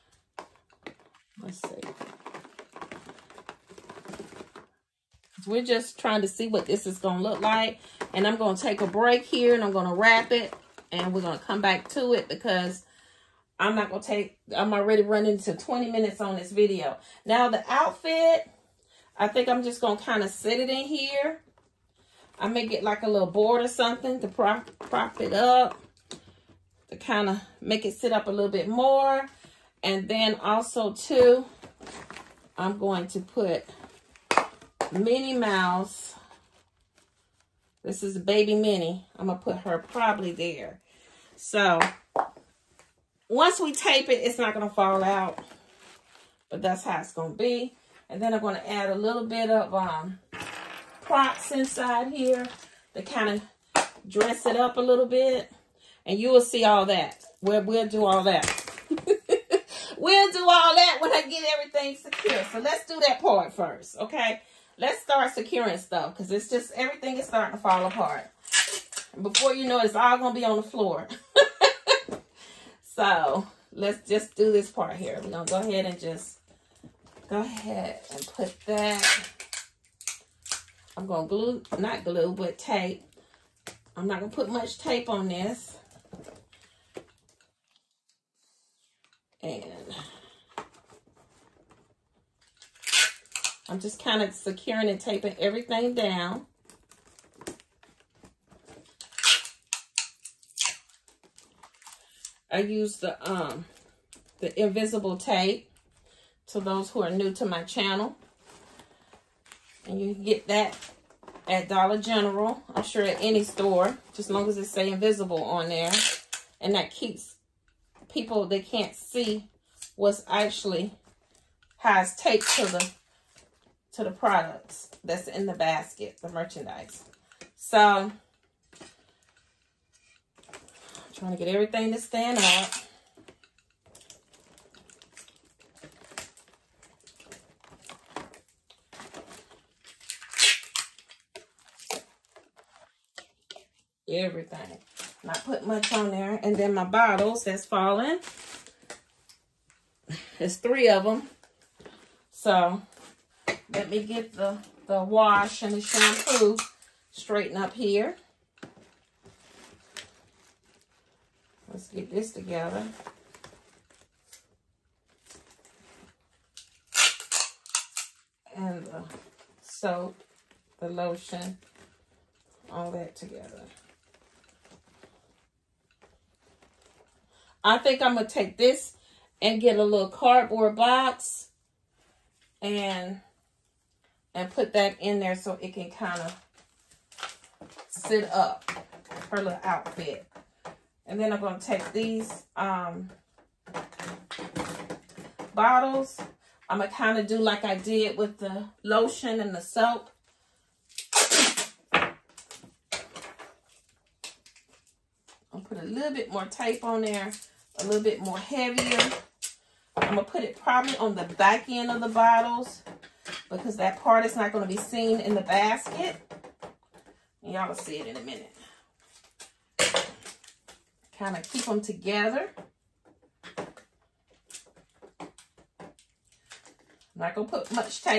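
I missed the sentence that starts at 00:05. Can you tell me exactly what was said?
We're just trying to see what this is going to look like.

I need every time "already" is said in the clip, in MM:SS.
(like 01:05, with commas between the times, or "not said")
00:14.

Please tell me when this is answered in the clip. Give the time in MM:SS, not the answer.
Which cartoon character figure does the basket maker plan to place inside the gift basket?
00:38.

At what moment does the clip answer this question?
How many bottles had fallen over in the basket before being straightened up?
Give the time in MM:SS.
02:30.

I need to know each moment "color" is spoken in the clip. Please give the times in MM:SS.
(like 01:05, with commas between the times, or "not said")
not said.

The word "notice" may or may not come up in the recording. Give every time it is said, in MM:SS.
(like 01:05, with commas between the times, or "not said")
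not said.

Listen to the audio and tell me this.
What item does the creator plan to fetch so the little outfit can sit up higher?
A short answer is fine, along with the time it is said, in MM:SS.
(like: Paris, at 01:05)
A little cardboard box, at 02:59.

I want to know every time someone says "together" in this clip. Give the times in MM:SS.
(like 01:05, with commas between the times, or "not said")
02:42, 02:53, 03:41.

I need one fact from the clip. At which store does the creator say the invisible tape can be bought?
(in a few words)
Dollar General.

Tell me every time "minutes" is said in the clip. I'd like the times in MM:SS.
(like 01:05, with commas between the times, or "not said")
00:15, 03:38.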